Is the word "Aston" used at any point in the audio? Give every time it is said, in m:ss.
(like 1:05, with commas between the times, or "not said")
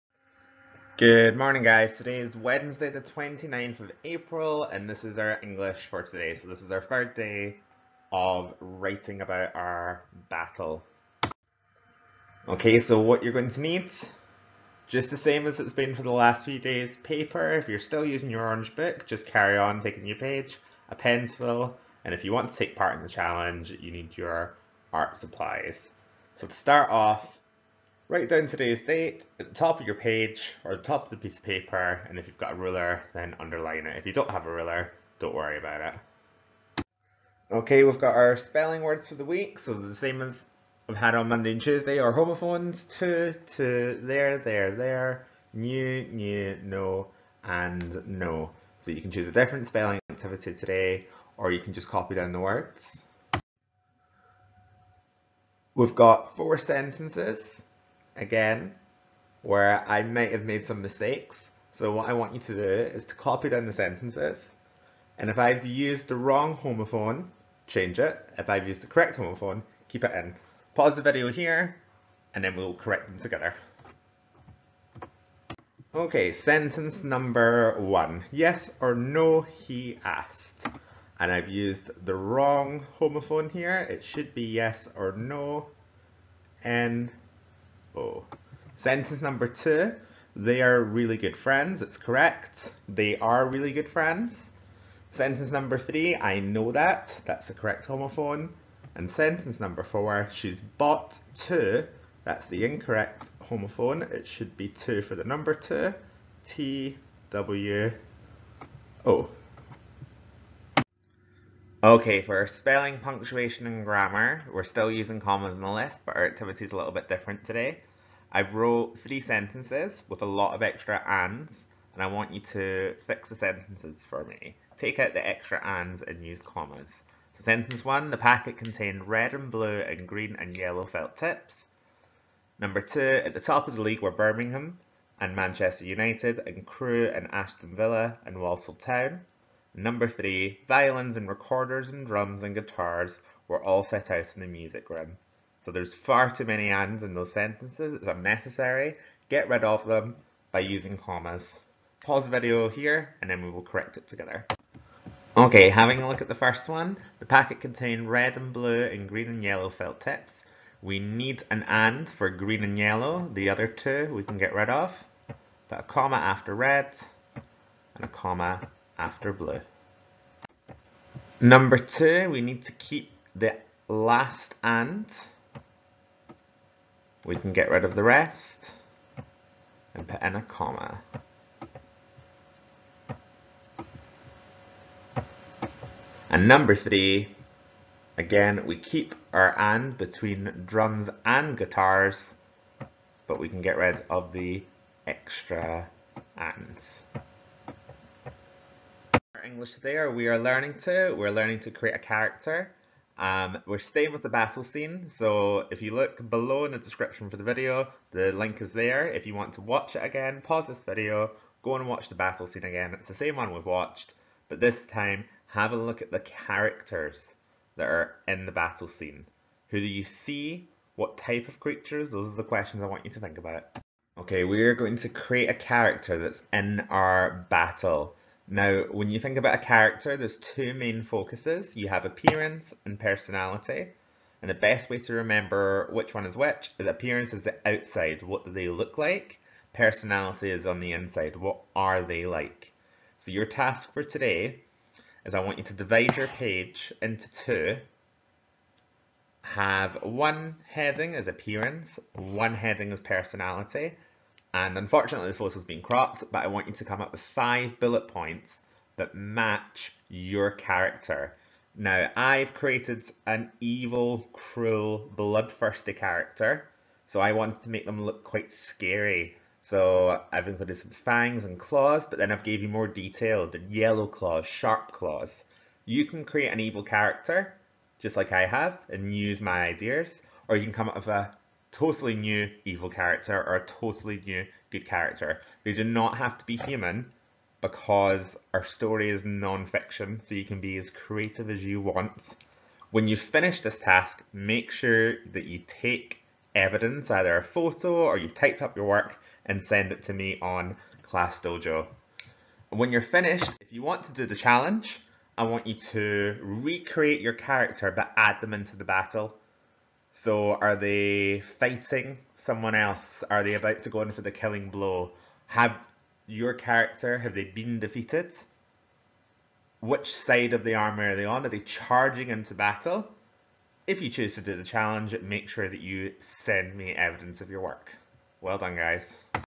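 2:17.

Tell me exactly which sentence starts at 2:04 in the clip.
Take out the extra ands and use commas.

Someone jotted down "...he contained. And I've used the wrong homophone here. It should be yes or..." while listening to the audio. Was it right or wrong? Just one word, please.
wrong.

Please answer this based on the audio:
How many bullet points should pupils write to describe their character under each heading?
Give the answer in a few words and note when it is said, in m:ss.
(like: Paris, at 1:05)
5, at 4:17.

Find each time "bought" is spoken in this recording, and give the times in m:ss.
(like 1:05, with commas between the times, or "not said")
1:40.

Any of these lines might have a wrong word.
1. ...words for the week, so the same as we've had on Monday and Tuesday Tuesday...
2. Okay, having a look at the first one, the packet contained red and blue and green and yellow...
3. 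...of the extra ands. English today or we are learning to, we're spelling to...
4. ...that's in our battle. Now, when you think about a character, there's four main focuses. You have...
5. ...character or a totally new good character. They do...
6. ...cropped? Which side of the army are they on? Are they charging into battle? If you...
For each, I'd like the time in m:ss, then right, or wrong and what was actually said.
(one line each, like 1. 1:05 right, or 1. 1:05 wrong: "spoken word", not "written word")
1. 0:38 wrong: "Our", not "Tuesday"
2. 2:35 right
3. 3:14 wrong: "learning", not "spelling"
4. 3:46 wrong: "two", not "four"
5. 4:42 right
6. 5:17 wrong: "defeated", not "cropped".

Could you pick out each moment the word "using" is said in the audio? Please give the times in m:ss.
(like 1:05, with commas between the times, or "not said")
0:18, 1:54, 2:30.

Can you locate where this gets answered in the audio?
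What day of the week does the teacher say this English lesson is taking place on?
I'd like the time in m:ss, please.
0:02.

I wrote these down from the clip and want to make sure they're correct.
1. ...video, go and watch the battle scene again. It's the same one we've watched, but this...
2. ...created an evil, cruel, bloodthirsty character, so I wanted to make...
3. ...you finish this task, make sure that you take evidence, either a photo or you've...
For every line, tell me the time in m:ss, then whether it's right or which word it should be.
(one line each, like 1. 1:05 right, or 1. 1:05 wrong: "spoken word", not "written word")
1. 3:30 right
2. 4:22 right
3. 4:53 right.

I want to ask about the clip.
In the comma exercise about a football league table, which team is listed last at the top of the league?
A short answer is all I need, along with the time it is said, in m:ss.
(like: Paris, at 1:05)
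Walsall Town, at 2:18.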